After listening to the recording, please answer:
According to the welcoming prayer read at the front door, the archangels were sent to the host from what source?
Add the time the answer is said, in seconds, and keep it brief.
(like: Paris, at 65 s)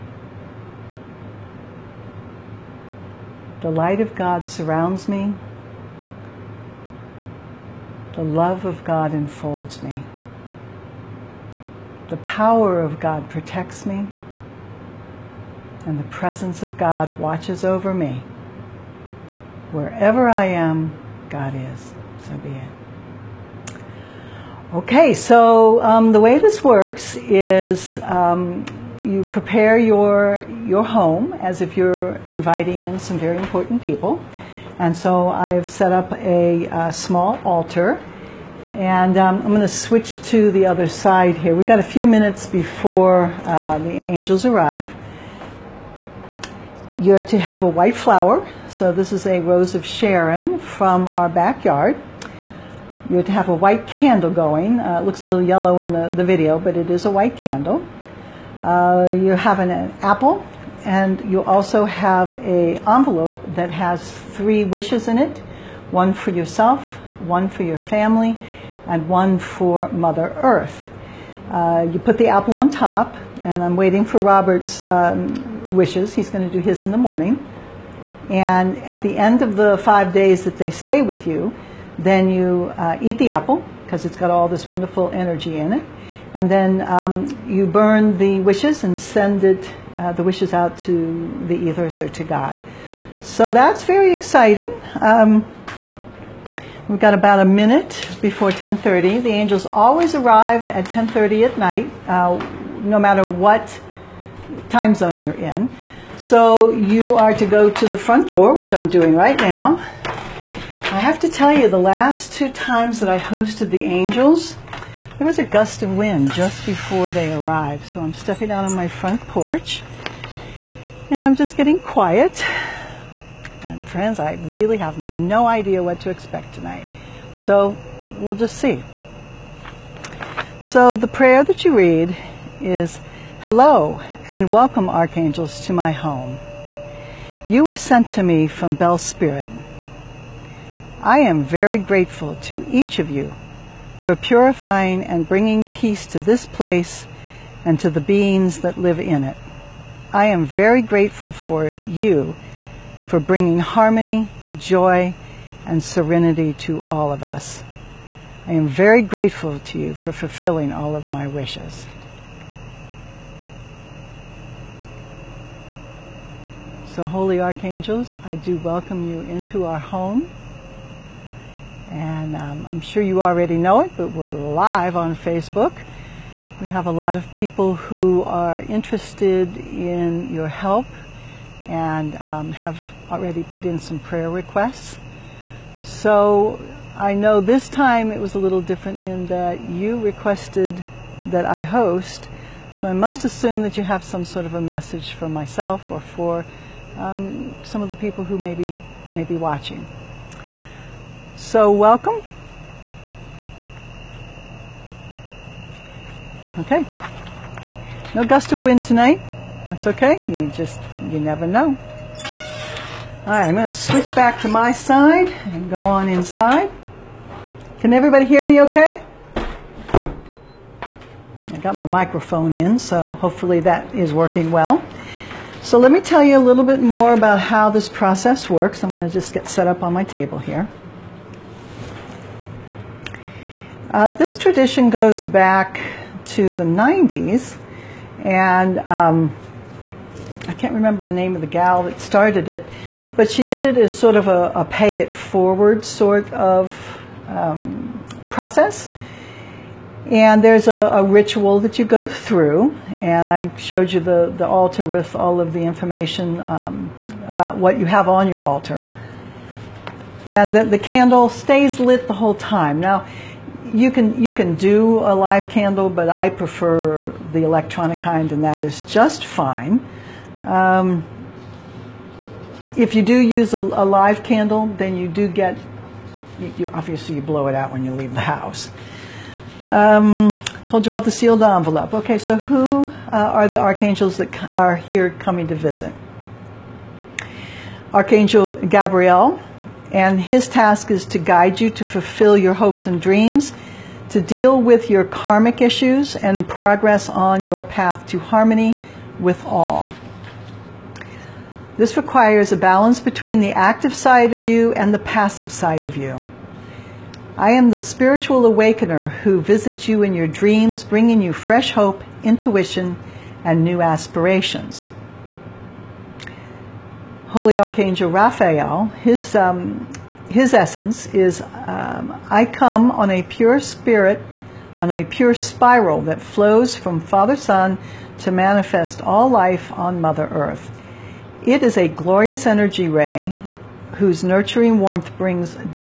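Bell Spirit, at 138 s.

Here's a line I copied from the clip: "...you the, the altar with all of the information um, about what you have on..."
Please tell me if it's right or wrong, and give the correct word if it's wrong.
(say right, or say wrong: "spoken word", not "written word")
right.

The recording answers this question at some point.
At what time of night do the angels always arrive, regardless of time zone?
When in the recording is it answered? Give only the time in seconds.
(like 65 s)
100 s.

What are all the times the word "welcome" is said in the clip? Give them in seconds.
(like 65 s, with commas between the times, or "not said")
134 s, 168 s, 201 s.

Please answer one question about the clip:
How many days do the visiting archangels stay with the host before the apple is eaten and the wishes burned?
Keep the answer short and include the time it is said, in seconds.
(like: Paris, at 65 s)
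5, at 79 s.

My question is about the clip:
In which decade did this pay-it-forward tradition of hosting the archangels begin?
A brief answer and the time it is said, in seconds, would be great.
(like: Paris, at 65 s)
The 90s, at 236 s.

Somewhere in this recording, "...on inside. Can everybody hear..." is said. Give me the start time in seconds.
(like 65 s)
215 s.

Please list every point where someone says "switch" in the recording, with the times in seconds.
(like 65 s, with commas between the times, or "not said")
39 s, 213 s.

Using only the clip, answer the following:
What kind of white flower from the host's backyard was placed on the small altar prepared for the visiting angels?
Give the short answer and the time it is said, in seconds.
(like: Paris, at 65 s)
Rose of Sharon, at 49 s.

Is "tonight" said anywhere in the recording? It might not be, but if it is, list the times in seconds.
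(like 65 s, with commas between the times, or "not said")
126 s, 208 s.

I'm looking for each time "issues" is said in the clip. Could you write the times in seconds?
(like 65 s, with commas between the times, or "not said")
295 s.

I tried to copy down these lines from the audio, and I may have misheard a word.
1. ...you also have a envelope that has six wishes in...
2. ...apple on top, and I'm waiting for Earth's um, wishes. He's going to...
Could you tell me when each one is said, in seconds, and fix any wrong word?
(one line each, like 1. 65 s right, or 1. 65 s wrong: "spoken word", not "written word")
1. 61 s wrong: "three", not "six"
2. 72 s wrong: "Robert", not "Earth".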